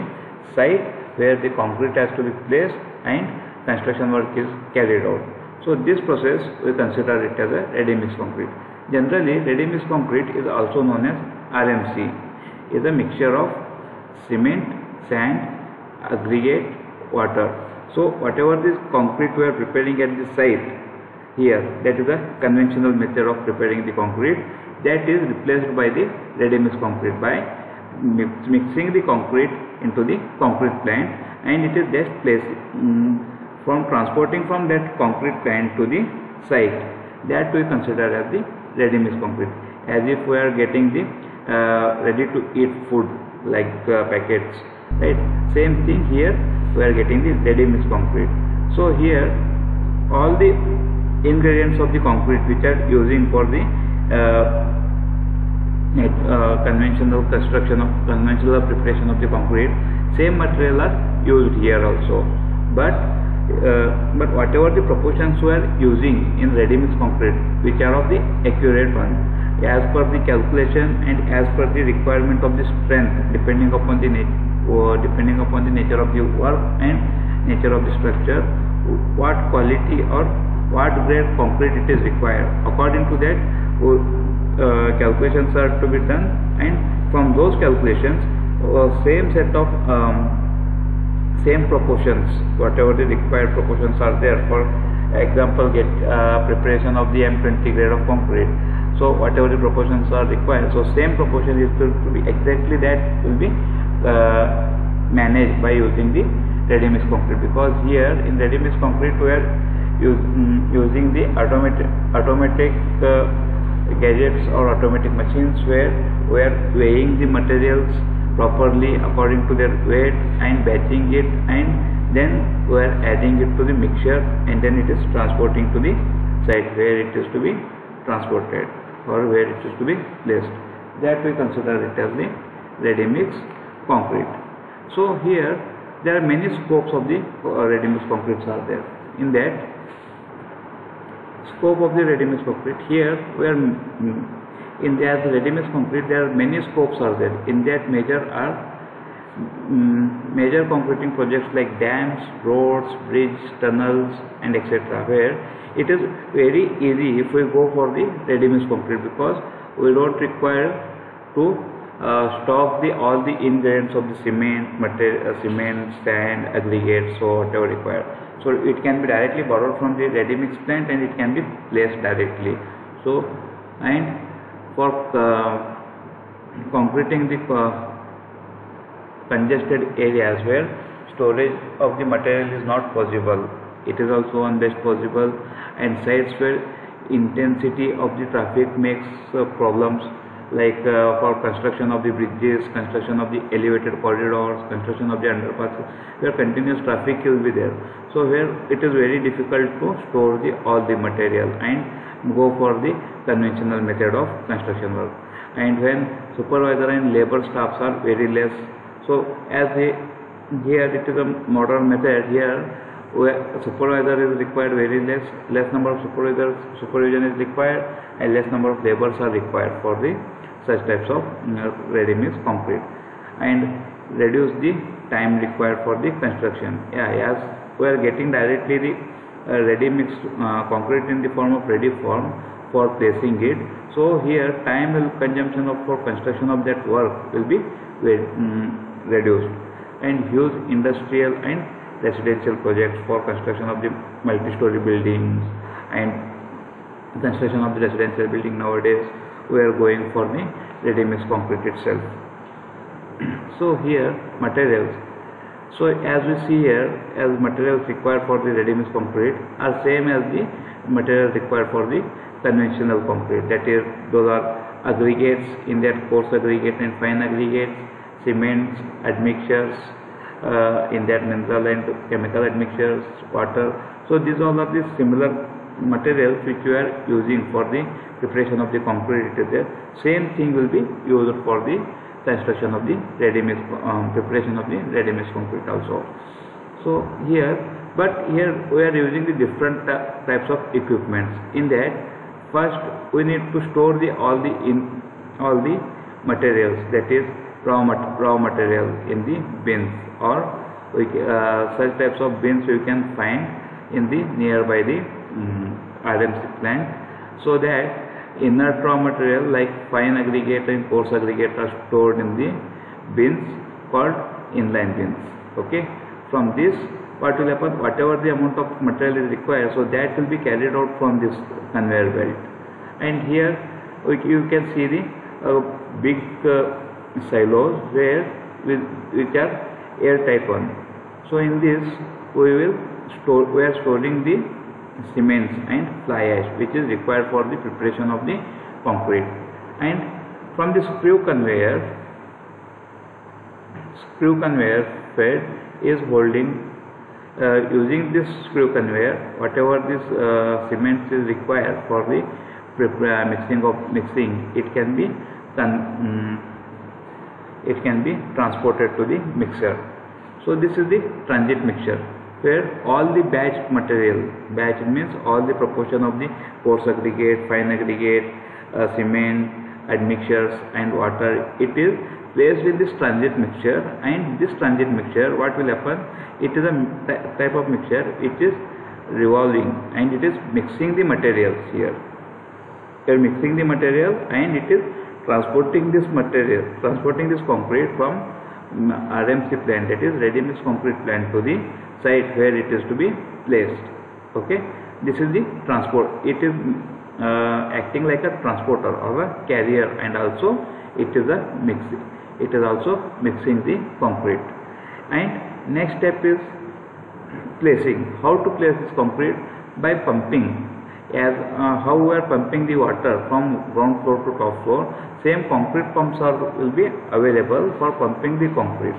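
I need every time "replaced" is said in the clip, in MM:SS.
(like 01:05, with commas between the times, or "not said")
00:25.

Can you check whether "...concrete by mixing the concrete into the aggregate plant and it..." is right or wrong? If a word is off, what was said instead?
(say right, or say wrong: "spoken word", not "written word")
wrong: "concrete", not "aggregate".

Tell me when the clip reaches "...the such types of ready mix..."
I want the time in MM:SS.
03:40.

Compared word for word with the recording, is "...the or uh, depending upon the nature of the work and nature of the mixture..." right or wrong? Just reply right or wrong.
wrong.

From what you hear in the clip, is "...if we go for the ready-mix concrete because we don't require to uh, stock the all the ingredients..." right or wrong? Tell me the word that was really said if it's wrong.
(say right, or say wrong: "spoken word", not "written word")
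right.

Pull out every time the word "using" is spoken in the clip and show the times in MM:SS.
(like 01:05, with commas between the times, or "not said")
00:52, 01:05, 01:45, 01:50, 04:37, 04:48, 05:47.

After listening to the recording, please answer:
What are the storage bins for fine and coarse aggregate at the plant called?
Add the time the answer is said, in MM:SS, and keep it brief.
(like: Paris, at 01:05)
inline bins, at 05:14.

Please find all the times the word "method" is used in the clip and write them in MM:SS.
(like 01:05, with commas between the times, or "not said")
00:22, 03:23, 03:31.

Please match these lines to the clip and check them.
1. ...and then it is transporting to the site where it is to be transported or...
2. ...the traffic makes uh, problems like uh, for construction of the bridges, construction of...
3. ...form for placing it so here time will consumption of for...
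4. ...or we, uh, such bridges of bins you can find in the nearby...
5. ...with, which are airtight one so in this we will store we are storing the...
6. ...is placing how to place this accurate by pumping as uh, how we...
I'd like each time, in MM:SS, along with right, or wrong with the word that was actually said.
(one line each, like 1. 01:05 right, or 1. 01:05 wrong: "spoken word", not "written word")
1. 02:04 right
2. 03:08 right
3. 03:52 right
4. 05:00 wrong: "types", not "bridges"
5. 05:28 right
6. 06:46 wrong: "concrete", not "accurate".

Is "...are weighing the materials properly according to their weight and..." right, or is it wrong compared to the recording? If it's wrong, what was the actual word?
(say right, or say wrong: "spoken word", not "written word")
right.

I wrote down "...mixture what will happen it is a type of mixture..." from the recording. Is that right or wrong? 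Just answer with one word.
right.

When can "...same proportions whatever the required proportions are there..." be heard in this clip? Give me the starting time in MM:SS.
01:31.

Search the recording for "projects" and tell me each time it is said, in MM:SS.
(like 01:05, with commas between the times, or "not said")
02:31, 04:02.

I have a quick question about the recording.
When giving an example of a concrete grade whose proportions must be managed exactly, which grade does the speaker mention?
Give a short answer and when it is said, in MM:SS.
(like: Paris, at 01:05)
M20, at 01:37.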